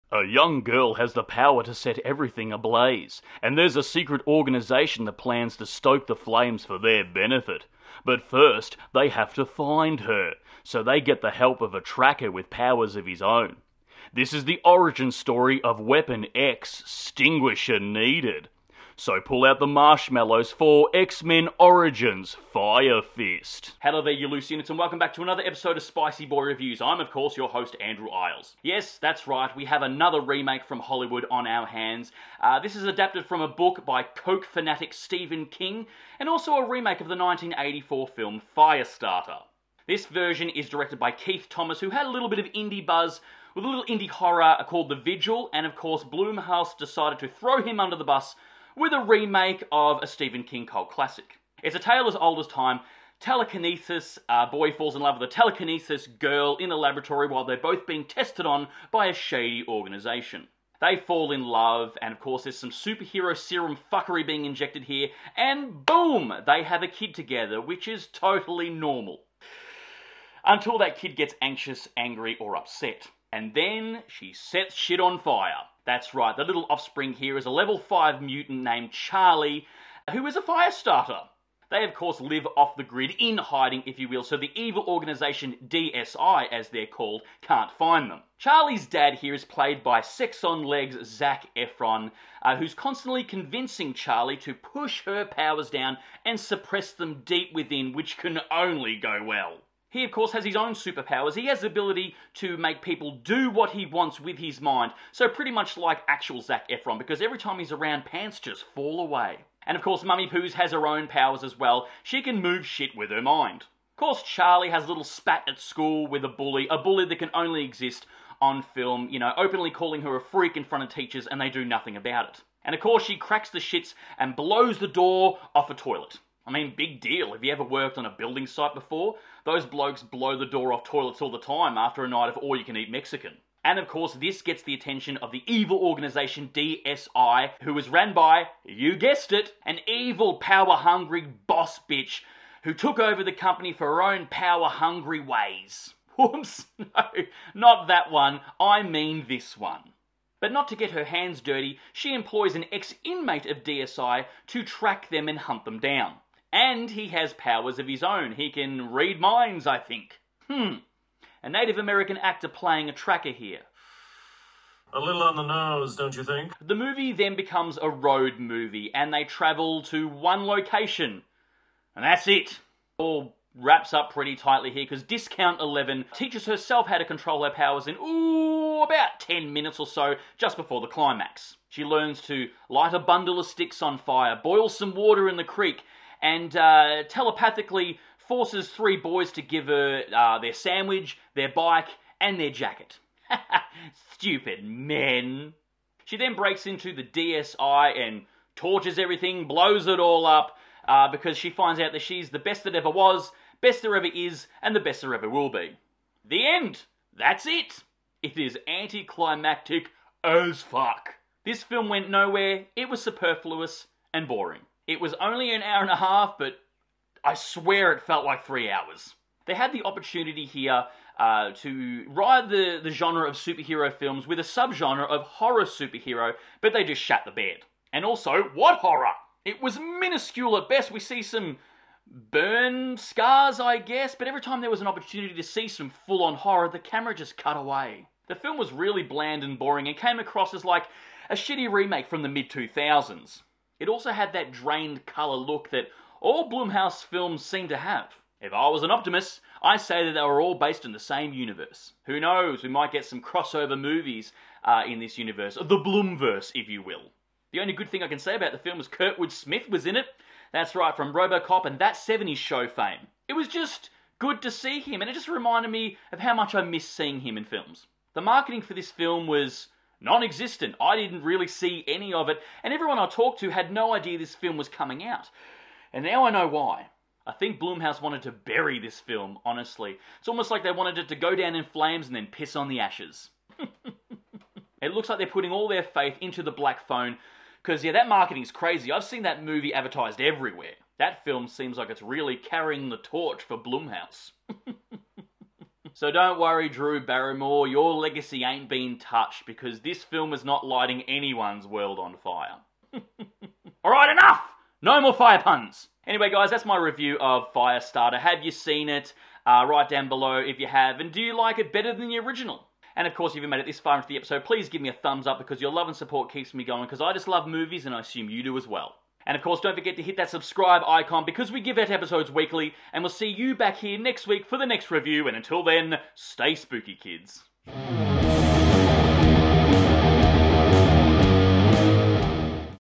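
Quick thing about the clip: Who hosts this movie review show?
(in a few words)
Andrew Iles.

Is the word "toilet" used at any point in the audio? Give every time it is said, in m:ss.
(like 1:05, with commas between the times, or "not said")
2:05, 2:10.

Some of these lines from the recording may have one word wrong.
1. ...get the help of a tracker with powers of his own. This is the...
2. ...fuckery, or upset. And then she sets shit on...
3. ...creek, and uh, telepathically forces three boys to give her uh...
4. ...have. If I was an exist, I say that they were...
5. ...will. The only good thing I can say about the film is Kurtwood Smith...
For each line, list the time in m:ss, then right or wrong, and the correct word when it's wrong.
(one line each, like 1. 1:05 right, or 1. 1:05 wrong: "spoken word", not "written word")
1. 0:10 right
2. 1:11 wrong: "angry", not "fuckery"
3. 3:05 right
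4. 4:07 wrong: "optimist", not "exist"
5. 4:16 right.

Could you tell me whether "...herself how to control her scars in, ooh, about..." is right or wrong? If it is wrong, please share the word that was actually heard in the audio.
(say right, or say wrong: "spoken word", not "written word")
wrong: "powers", not "scars".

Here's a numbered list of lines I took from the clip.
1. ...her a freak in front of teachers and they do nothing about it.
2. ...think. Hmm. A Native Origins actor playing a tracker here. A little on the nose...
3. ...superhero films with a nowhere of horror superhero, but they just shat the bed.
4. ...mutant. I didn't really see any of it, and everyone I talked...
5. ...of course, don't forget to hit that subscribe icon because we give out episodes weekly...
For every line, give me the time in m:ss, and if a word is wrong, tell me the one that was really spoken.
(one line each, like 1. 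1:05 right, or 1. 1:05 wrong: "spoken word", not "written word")
1. 2:00 right
2. 2:39 wrong: "American", not "Origins"
3. 3:43 wrong: "subgenre", not "nowhere"
4. 4:30 wrong: "existent", not "mutant"
5. 5:19 right.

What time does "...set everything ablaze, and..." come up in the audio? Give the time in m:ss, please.
0:01.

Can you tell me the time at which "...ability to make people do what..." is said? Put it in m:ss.
1:41.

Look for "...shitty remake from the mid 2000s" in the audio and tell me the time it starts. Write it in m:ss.
4:01.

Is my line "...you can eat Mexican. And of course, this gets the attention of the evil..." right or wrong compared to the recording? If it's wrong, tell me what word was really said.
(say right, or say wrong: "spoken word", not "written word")
right.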